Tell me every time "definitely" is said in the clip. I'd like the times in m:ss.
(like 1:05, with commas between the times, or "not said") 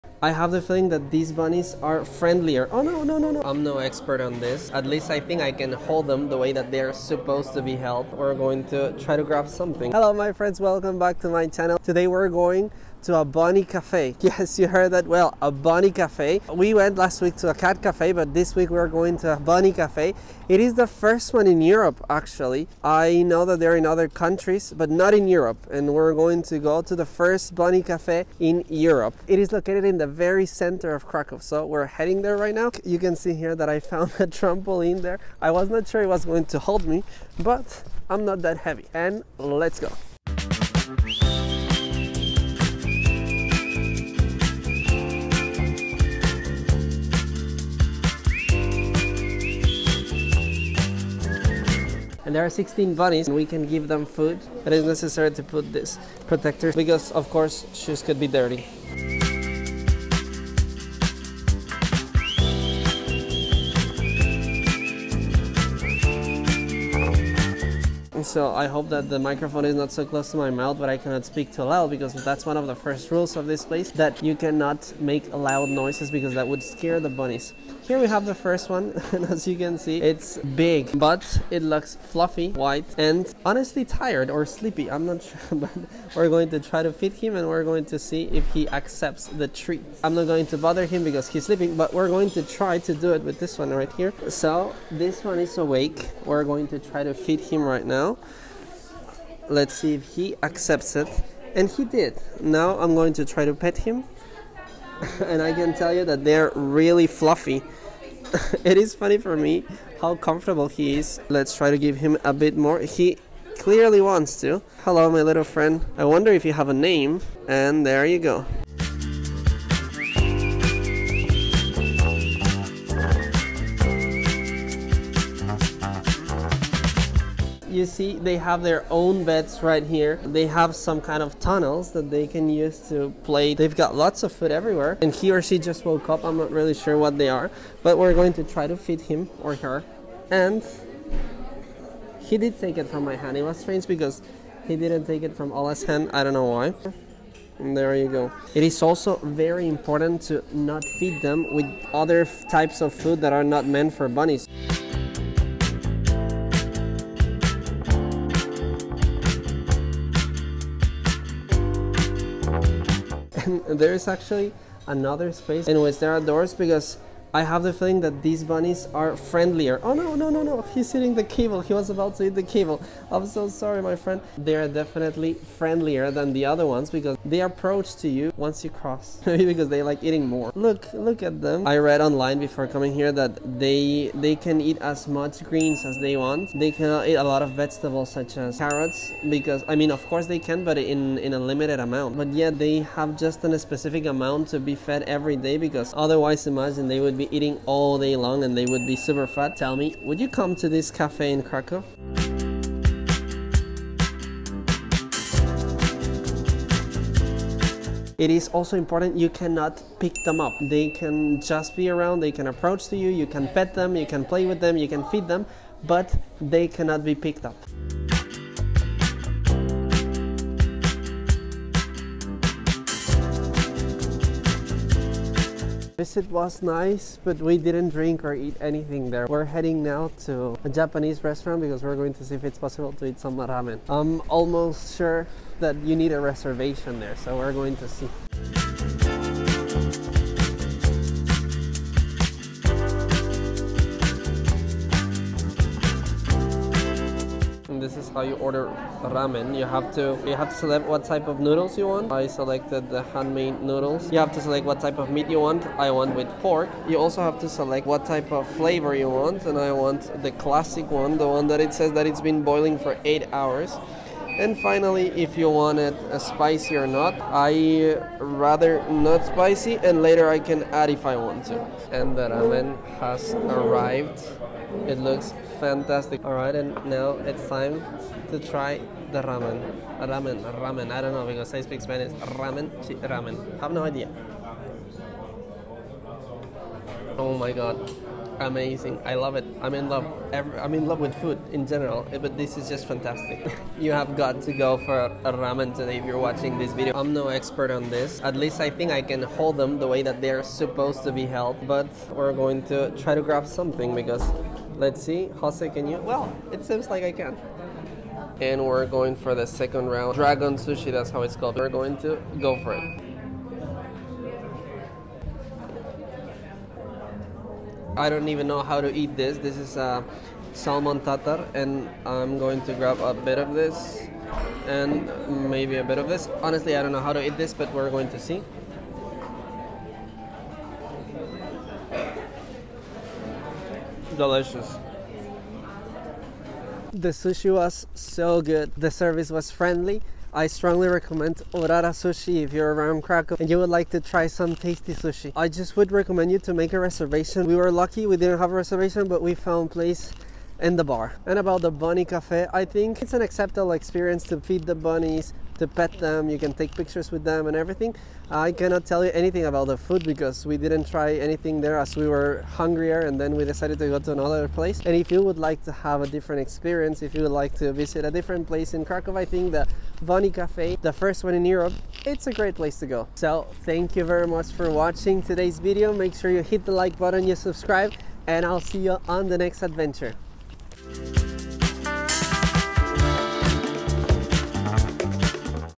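2:54.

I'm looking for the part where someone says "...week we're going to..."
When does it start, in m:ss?
0:18.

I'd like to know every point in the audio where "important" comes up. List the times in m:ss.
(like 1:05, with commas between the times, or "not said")
2:29, 3:28.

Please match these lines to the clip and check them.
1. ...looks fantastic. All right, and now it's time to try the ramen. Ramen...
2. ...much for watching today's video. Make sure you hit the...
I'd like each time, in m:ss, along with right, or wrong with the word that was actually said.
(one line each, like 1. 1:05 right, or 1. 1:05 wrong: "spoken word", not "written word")
1. 4:34 right
2. 6:14 right.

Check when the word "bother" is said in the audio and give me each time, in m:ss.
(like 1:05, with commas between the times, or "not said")
1:30.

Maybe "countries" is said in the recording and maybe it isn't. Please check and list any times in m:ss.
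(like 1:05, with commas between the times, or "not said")
0:24.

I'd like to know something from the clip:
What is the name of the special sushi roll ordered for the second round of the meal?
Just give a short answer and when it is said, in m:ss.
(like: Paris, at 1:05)
Dragon sushi, at 5:10.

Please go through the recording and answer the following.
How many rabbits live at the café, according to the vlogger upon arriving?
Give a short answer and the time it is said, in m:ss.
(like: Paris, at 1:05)
16, at 0:52.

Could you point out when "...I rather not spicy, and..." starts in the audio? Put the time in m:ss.
4:27.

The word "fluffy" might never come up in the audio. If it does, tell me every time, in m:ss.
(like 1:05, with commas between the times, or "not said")
1:21, 1:47.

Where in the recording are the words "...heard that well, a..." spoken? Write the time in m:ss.
0:14.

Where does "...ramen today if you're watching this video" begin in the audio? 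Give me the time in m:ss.
4:55.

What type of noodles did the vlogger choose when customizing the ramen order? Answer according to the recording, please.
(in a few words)
Handmade noodles.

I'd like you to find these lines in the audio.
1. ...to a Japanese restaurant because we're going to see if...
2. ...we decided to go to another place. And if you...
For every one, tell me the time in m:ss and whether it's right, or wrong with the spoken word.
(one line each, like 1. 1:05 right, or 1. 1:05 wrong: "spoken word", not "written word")
1. 3:50 right
2. 6:03 right.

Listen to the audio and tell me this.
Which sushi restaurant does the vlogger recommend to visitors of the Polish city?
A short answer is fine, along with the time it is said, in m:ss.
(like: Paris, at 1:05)
Urara Sushi, at 5:41.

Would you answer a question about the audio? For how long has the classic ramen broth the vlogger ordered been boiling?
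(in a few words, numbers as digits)
8 hours.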